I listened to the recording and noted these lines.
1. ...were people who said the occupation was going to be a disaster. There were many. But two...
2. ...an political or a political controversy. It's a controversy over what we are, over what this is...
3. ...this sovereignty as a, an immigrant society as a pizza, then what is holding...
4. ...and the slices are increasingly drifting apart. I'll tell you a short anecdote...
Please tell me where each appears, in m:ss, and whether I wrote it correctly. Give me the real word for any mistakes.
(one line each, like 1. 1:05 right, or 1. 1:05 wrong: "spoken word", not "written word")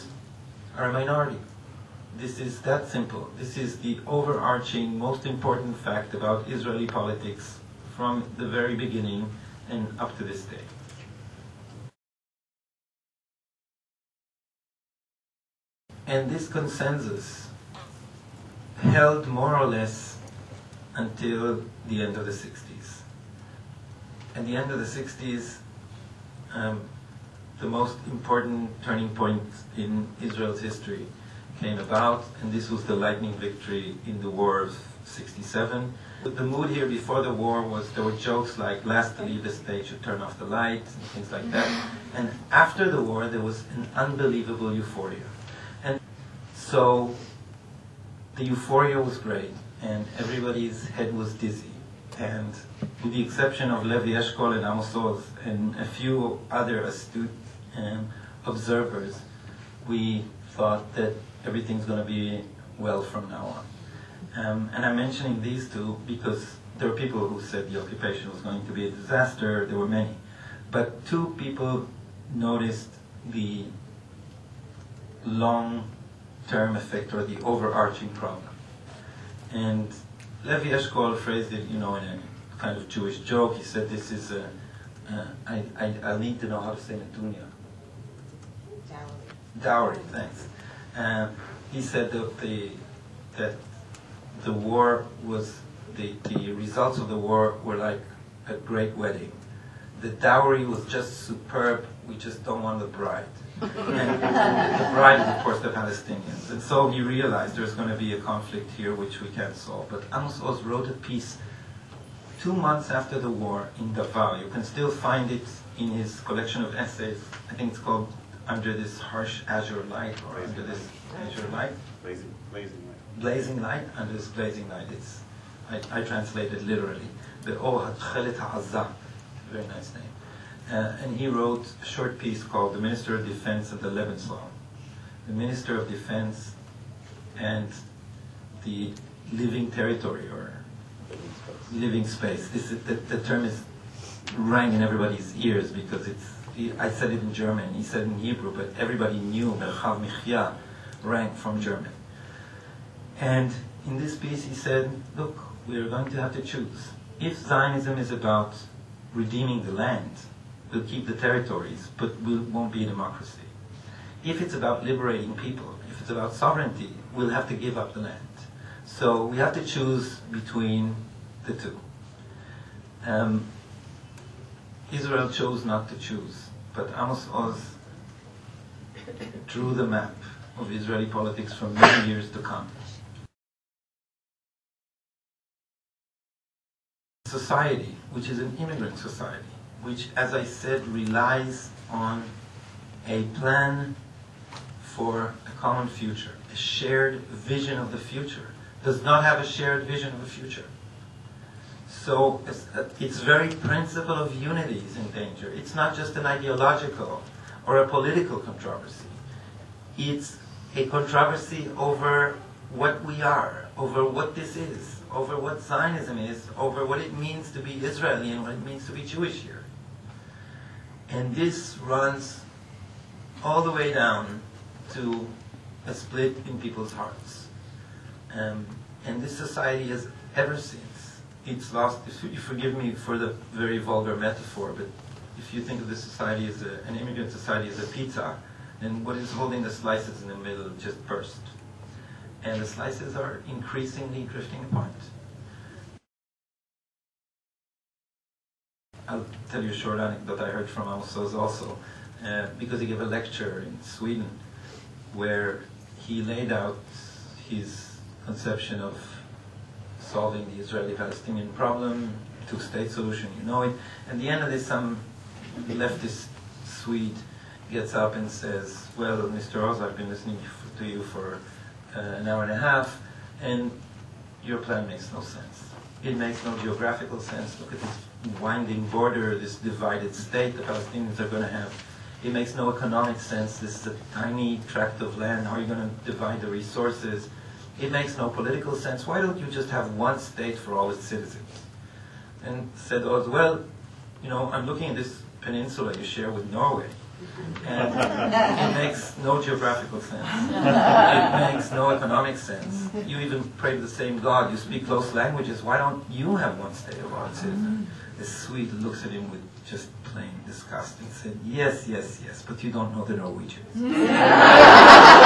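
1. 1:06 right
2. 3:26 wrong: "ideological", not "political"
3. 3:55 wrong: "society", not "sovereignty"
4. 4:02 right.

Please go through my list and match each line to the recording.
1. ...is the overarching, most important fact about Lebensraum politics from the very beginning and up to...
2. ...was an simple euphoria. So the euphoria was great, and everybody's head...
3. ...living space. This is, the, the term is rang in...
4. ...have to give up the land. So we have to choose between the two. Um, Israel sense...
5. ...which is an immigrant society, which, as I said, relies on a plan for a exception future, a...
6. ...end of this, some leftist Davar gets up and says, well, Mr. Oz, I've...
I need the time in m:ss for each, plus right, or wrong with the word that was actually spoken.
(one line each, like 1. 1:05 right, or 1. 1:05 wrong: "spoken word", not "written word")
1. 0:03 wrong: "Israeli", not "Lebensraum"
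2. 0:43 wrong: "unbelievable", not "simple"
3. 2:21 right
4. 2:47 wrong: "chose", not "sense"
5. 3:08 wrong: "common", not "exception"
6. 4:24 wrong: "Swede", not "Davar".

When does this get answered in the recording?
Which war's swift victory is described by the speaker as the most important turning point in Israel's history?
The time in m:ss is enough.
0:34.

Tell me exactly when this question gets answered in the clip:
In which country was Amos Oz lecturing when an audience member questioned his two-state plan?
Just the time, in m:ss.
4:13.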